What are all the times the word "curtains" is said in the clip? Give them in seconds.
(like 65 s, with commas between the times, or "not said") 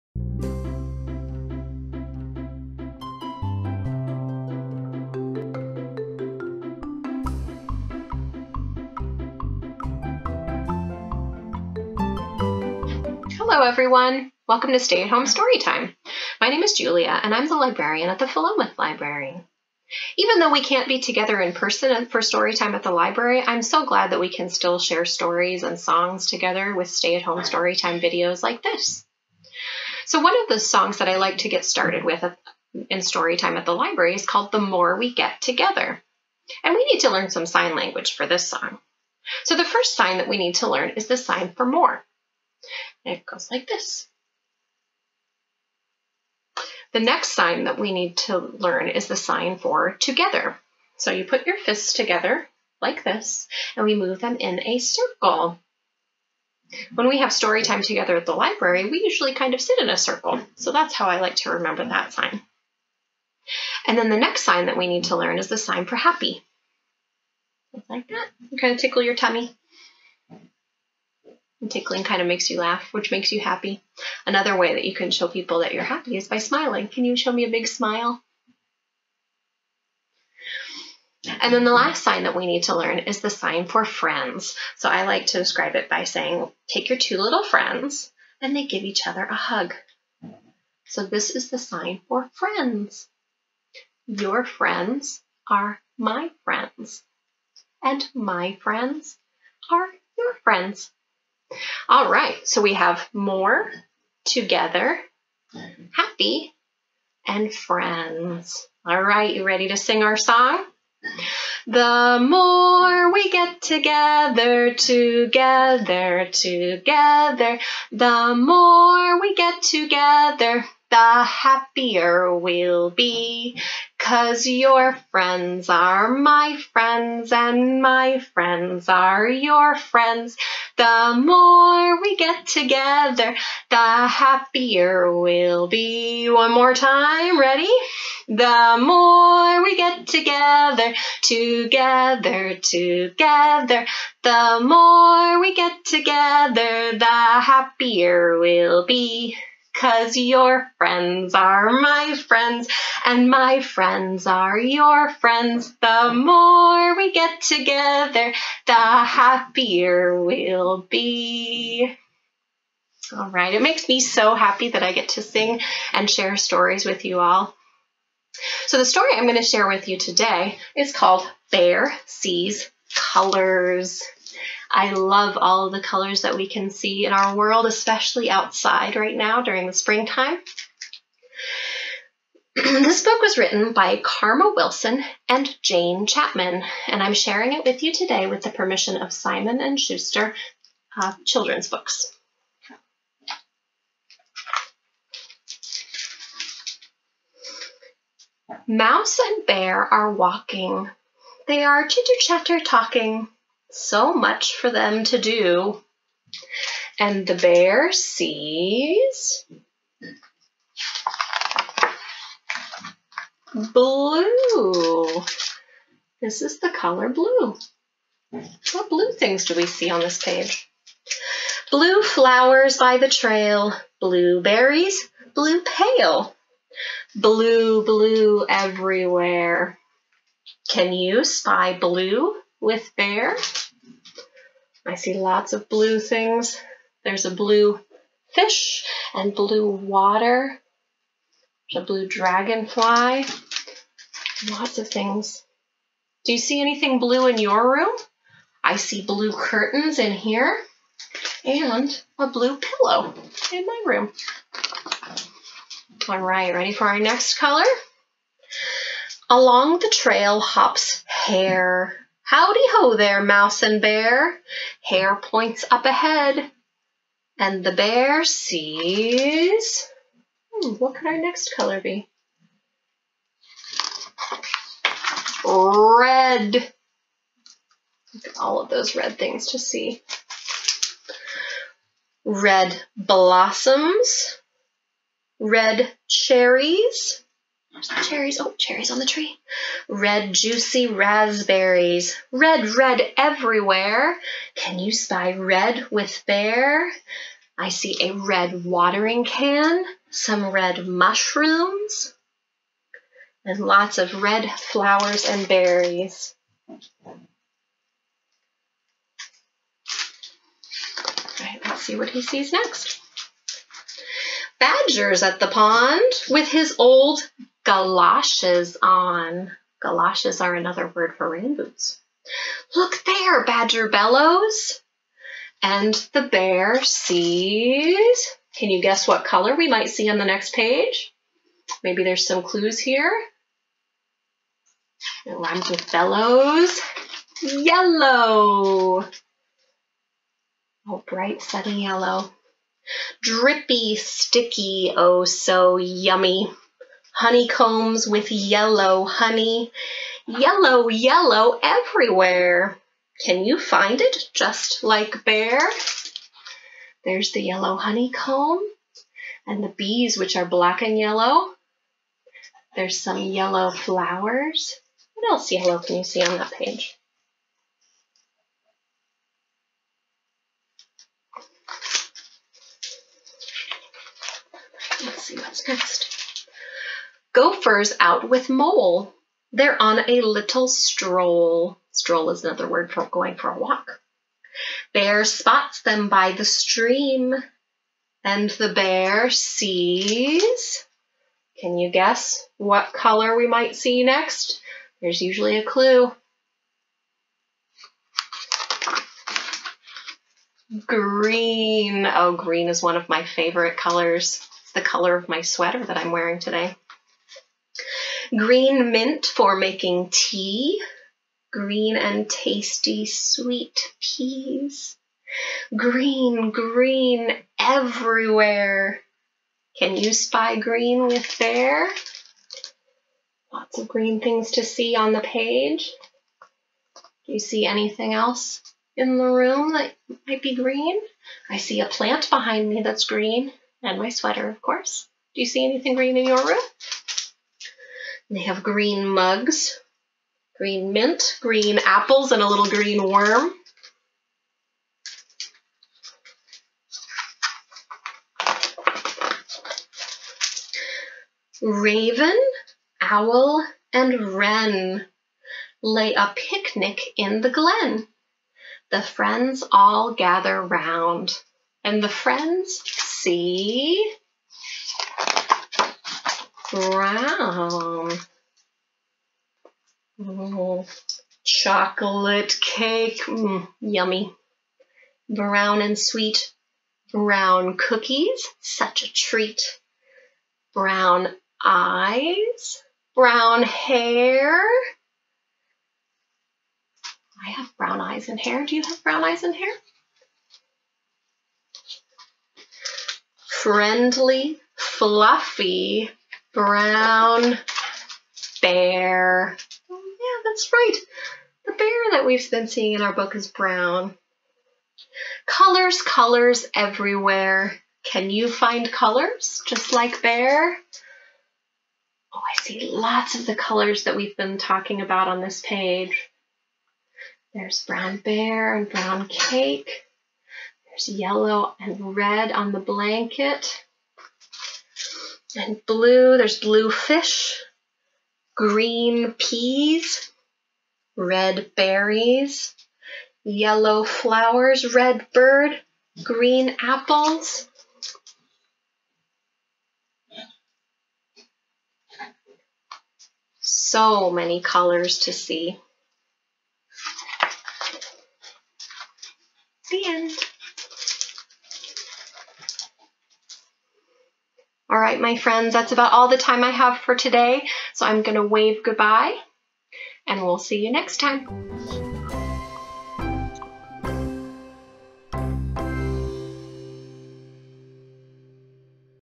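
249 s.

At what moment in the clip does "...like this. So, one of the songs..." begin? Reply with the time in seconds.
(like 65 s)
28 s.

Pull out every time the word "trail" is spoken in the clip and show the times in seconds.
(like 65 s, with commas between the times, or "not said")
223 s, 259 s.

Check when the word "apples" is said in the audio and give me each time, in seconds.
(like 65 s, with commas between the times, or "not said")
441 s, 536 s.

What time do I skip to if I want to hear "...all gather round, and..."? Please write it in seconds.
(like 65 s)
459 s.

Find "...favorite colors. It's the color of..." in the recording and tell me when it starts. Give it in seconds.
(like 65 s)
403 s.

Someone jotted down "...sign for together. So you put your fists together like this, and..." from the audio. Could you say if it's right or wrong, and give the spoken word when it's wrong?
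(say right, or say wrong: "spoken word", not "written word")
right.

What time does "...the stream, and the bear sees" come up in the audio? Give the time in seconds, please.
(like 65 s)
386 s.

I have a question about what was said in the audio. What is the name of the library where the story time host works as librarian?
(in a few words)
Philomath Library.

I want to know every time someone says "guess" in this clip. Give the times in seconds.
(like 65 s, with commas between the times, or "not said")
328 s, 391 s.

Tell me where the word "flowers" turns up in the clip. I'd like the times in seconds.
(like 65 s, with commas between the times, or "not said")
222 s, 304 s, 363 s, 534 s.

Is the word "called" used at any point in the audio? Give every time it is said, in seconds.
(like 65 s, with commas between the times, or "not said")
34 s, 170 s.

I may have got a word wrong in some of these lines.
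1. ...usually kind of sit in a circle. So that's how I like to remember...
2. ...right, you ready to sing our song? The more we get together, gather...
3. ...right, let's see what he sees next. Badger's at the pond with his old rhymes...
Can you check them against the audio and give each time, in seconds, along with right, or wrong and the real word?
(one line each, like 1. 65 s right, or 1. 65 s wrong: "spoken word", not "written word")
1. 59 s right
2. 109 s wrong: "together", not "gather"
3. 311 s wrong: "galoshes", not "rhymes".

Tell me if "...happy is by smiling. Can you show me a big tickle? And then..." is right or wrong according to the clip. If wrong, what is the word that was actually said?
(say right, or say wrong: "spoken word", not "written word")
wrong: "smile", not "tickle".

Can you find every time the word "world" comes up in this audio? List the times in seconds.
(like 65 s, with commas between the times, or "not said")
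177 s.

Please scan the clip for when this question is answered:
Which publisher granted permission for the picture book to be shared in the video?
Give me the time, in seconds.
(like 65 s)
189 s.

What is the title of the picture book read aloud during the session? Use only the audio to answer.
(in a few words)
Bear Sees Colors.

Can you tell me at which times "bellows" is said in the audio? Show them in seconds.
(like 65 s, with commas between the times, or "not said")
323 s, 335 s.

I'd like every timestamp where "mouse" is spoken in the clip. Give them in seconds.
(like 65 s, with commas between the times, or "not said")
198 s, 263 s.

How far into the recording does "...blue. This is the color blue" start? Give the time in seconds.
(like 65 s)
213 s.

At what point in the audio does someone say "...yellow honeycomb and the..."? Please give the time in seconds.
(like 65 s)
357 s.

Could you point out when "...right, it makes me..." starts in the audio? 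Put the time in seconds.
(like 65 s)
163 s.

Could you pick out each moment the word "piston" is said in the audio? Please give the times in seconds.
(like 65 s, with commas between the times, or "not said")
not said.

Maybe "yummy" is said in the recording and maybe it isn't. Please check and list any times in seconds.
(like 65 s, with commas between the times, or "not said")
345 s, 473 s.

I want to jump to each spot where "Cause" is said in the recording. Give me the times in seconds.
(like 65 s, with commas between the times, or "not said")
123 s, 149 s.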